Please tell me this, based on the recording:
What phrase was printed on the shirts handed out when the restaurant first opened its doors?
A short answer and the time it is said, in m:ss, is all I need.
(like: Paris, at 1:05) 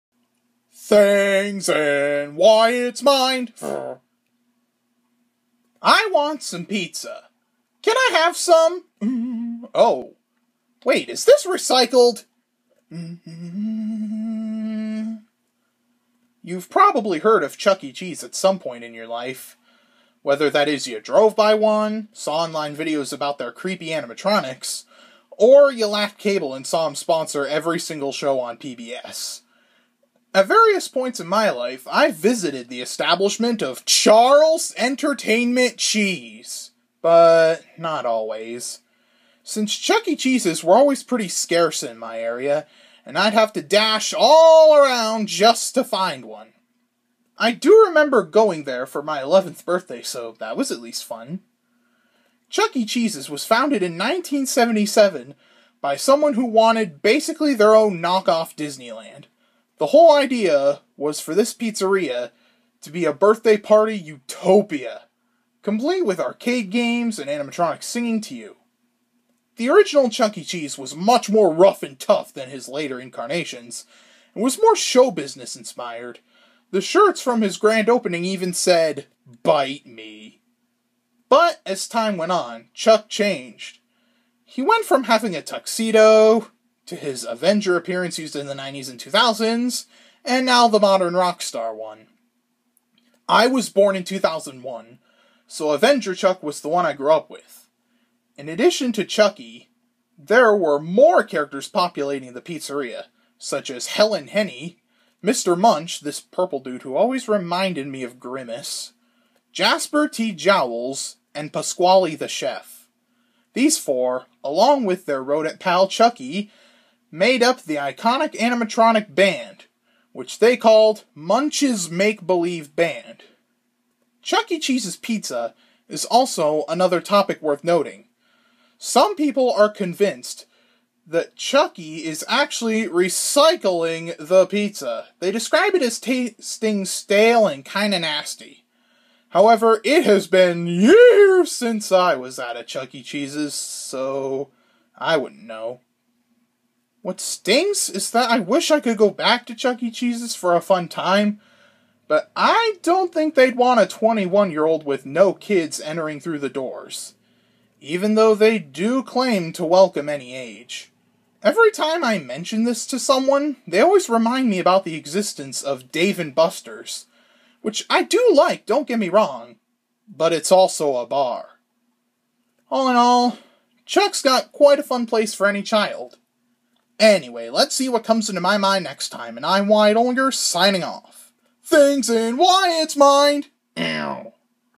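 Bite me, at 1:19.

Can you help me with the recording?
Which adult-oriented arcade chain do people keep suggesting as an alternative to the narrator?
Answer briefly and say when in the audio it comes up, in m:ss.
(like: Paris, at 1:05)
Dave and Buster's, at 2:45.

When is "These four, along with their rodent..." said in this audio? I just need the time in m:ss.
1:53.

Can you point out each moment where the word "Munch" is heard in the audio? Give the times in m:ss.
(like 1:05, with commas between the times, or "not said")
1:45, 2:01.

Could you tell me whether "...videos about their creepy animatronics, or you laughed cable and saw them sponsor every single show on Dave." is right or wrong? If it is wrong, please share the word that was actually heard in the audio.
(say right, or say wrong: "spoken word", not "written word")
wrong: "PBS", not "Dave".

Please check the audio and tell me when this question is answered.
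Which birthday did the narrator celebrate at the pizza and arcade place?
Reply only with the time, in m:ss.
0:49.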